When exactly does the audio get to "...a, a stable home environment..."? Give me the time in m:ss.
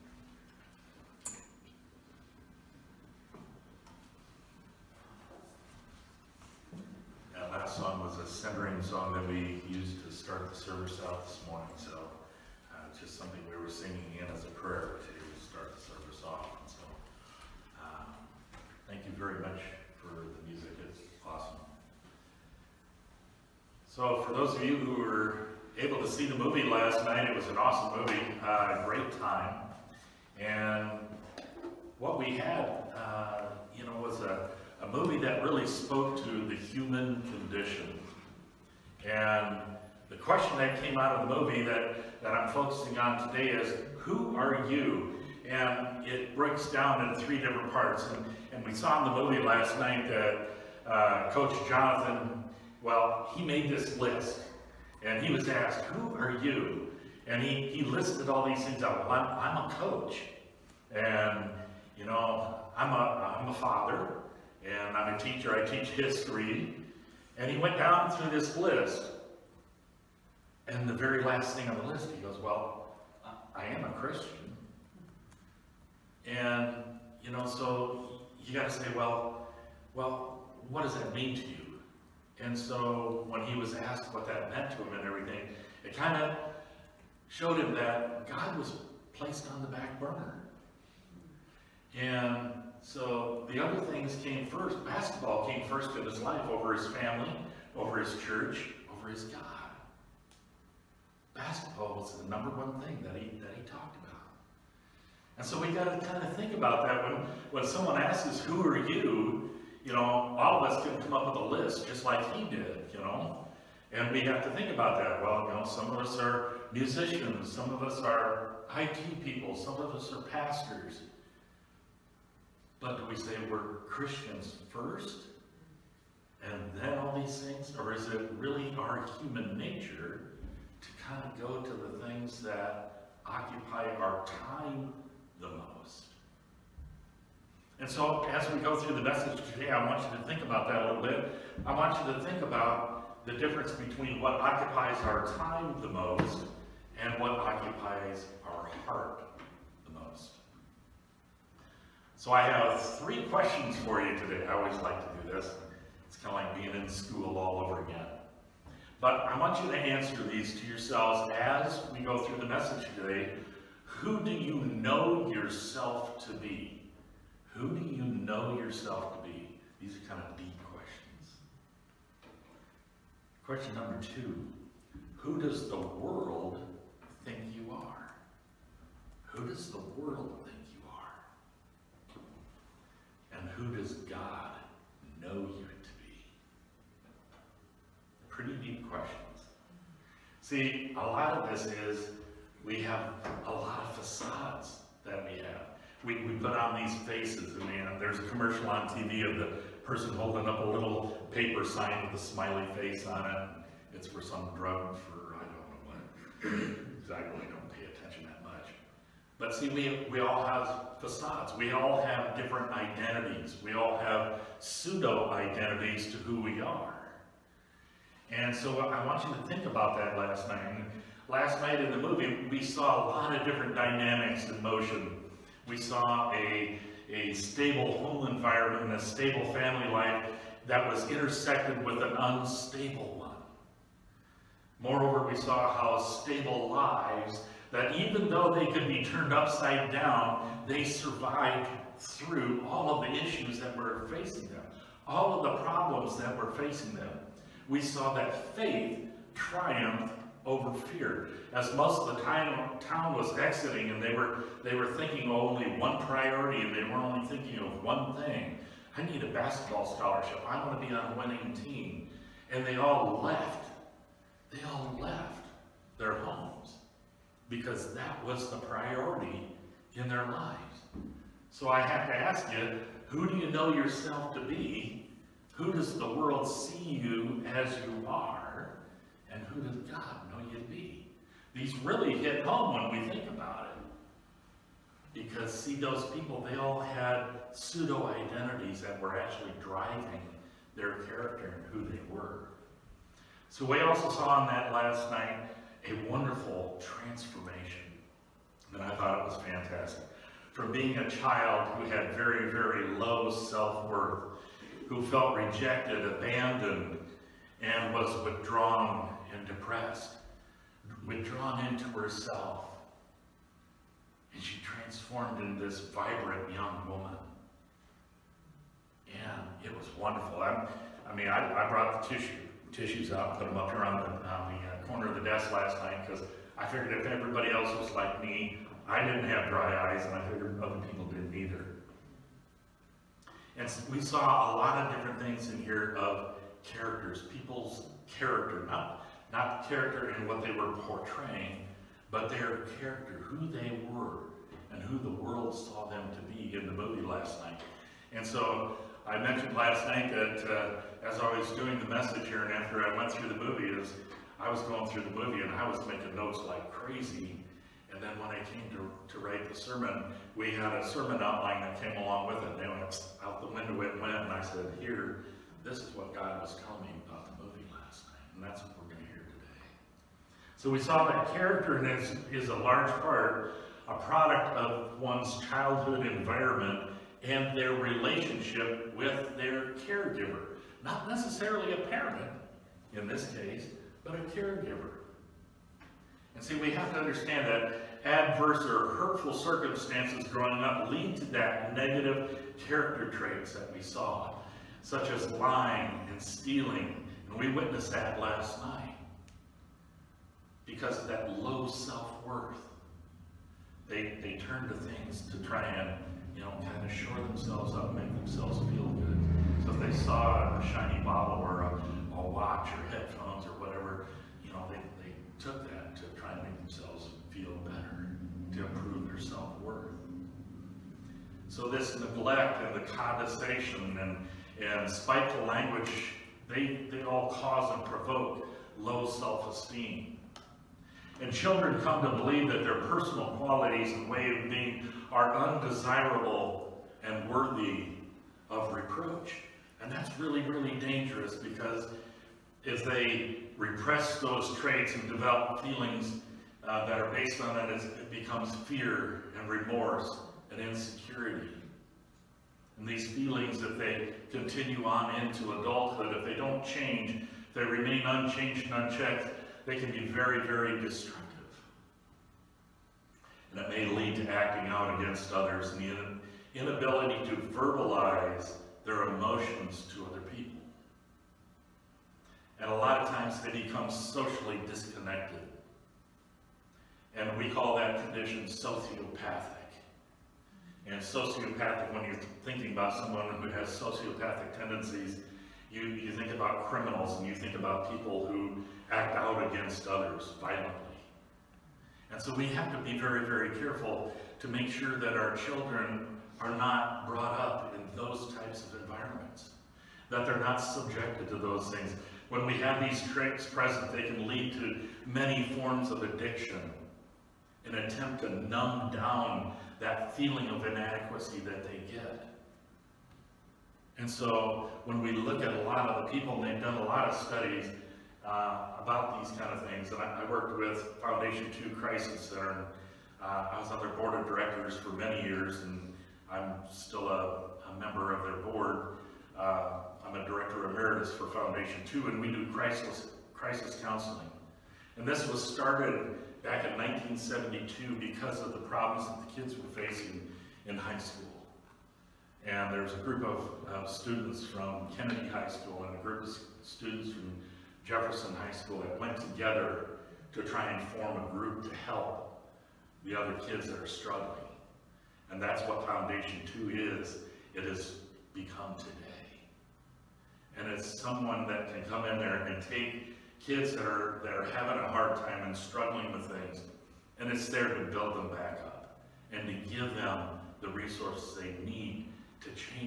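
3:46.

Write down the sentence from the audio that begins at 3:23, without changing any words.
It's for some drug for, I don't know what.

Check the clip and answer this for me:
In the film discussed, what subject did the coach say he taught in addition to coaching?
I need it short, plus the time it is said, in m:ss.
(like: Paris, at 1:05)
History, at 1:05.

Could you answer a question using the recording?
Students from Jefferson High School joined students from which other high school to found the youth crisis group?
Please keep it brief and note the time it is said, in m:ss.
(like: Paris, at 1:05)
Kennedy High School, at 9:04.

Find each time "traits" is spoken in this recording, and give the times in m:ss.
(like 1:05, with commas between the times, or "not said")
6:33, 7:24.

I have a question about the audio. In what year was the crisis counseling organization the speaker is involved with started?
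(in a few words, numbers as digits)
1972.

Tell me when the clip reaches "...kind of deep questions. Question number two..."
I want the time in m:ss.
2:50.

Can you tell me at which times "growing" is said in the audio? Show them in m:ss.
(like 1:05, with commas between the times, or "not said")
6:30.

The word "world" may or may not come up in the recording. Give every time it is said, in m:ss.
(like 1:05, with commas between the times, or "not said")
2:55, 2:59, 4:36, 5:45.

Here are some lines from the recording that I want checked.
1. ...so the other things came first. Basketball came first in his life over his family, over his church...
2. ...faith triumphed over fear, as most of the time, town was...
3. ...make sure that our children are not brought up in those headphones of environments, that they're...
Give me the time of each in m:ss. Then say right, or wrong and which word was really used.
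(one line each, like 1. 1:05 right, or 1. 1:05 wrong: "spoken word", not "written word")
1. 1:32 right
2. 4:08 right
3. 8:14 wrong: "types", not "headphones".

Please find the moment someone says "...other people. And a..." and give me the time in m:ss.
7:50.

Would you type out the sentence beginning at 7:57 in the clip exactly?
And we call that condition sociopathic.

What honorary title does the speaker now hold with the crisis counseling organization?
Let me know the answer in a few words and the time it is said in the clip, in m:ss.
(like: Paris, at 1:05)
Director emeritus, at 8:50.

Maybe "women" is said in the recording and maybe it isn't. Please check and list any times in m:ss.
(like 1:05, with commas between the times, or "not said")
not said.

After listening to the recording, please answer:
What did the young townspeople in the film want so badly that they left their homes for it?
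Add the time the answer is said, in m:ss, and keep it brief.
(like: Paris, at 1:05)
A basketball scholarship, at 4:19.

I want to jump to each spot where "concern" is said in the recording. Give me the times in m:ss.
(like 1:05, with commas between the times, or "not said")
not said.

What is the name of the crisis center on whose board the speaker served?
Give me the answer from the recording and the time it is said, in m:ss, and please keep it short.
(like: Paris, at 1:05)
Foundation 2, at 8:41.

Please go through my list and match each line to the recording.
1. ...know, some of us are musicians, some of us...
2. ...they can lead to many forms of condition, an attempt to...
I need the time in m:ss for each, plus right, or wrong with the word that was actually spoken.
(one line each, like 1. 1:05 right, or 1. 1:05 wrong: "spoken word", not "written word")
1. 1:55 right
2. 8:23 wrong: "addiction", not "condition".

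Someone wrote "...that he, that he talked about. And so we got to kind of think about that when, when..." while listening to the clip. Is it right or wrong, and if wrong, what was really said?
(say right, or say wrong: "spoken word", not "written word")
right.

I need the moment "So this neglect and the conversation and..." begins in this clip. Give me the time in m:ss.
7:01.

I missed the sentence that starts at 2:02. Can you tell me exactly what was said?
But do we say we're Christians first and then all these things?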